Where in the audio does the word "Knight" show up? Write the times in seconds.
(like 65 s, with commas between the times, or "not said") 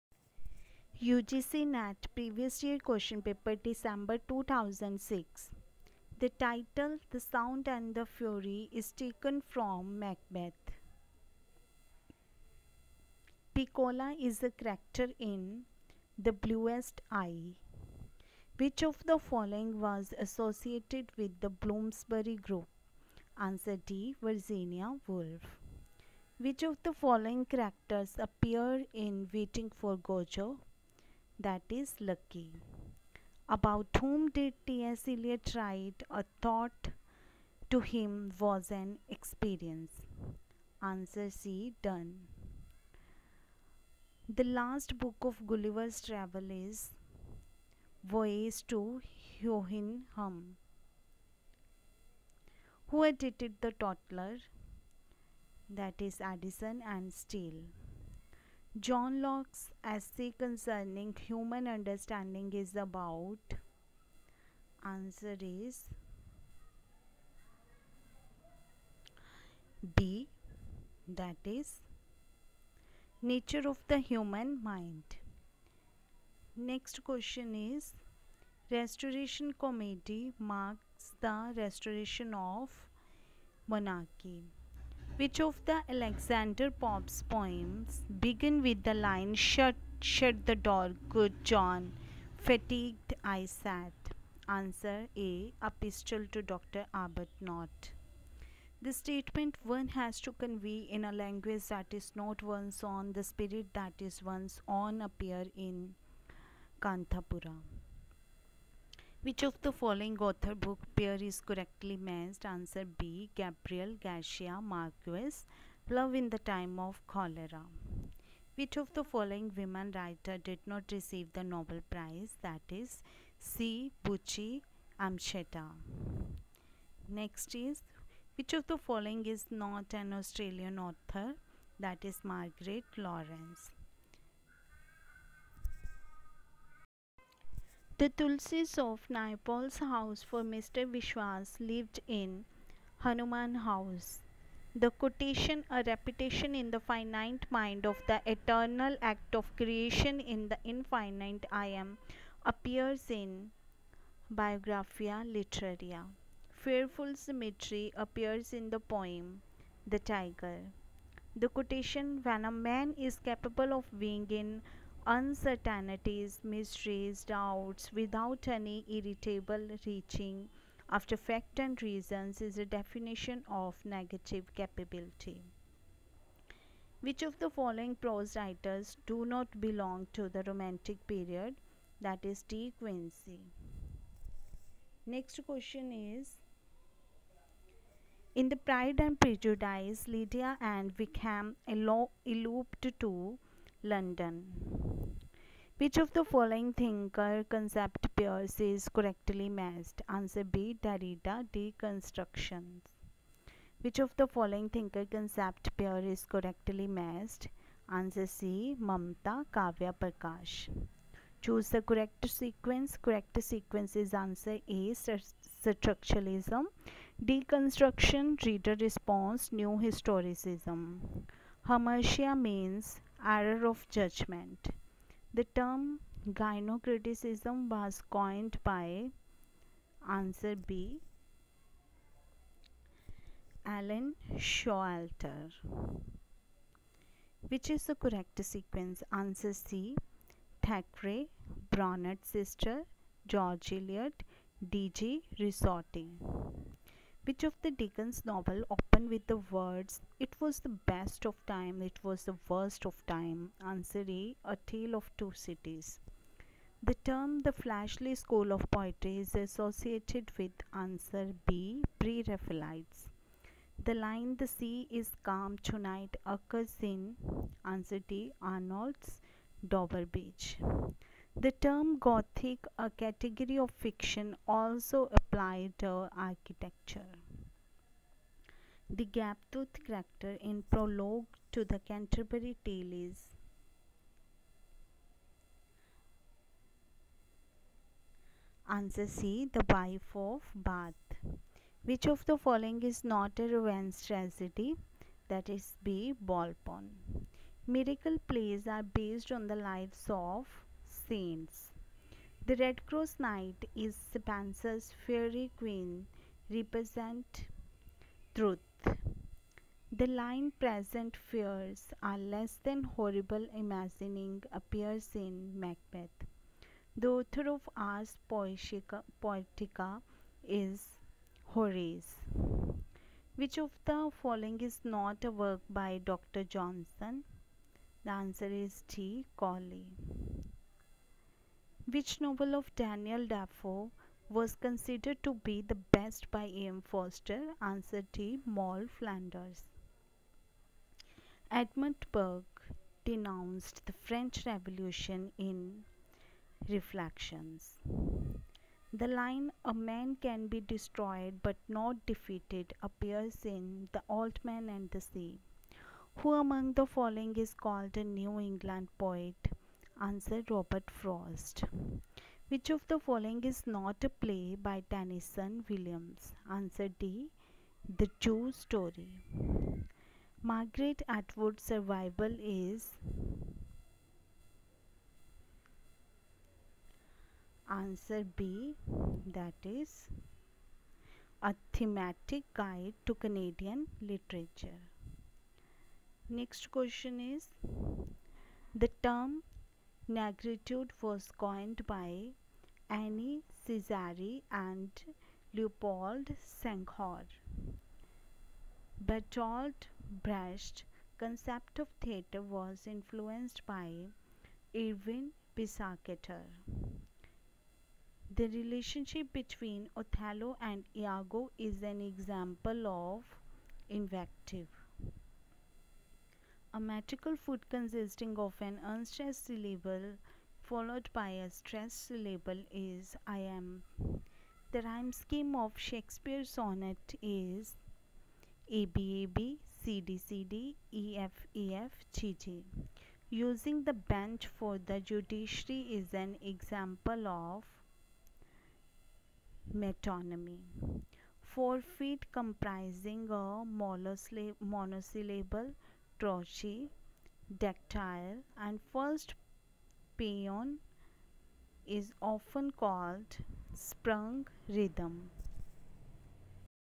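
303 s.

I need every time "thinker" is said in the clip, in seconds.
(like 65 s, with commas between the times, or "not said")
196 s, 204 s.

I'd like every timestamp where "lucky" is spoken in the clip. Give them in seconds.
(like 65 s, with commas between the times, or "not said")
31 s.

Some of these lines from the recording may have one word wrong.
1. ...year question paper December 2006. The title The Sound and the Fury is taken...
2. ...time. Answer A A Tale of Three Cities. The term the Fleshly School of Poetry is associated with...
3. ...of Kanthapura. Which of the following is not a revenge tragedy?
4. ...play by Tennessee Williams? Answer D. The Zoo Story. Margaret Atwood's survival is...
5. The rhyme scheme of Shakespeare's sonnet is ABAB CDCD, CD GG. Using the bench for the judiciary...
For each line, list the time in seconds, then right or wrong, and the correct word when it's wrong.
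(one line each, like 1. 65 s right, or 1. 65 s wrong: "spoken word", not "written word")
1. 2 s right
2. 253 s wrong: "Two", not "Three"
3. 290 s wrong: "Bath", not "Kanthapura"
4. 364 s right
5. 424 s right.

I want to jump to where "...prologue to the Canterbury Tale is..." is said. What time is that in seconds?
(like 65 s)
280 s.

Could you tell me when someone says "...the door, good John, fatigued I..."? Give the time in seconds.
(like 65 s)
90 s.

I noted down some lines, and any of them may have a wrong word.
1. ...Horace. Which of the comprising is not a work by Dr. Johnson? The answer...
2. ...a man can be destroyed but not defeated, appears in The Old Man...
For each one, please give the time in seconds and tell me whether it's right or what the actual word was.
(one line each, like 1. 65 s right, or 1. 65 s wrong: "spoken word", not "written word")
1. 321 s wrong: "following", not "comprising"
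2. 349 s right.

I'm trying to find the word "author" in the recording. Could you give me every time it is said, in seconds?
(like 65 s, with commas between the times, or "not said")
110 s, 130 s, 317 s.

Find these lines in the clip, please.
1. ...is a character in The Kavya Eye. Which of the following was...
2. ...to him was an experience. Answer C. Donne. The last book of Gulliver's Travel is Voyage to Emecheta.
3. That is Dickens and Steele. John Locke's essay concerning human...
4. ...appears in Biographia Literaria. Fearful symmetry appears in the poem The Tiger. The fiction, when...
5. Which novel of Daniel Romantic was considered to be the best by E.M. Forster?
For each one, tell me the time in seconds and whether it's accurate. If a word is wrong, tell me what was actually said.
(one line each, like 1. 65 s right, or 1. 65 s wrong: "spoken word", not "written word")
1. 14 s wrong: "Bluest", not "Kavya"
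2. 37 s wrong: "Hum", not "Emecheta"
3. 55 s wrong: "Addison", not "Dickens"
4. 152 s wrong: "quotation", not "fiction"
5. 331 s wrong: "Defoe", not "Romantic".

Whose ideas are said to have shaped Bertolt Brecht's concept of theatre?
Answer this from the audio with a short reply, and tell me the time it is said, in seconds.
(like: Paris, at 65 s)
Erwin Piscator, at 404 s.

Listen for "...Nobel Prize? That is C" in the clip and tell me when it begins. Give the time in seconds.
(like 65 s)
121 s.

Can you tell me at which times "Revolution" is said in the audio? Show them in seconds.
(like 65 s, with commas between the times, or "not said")
344 s.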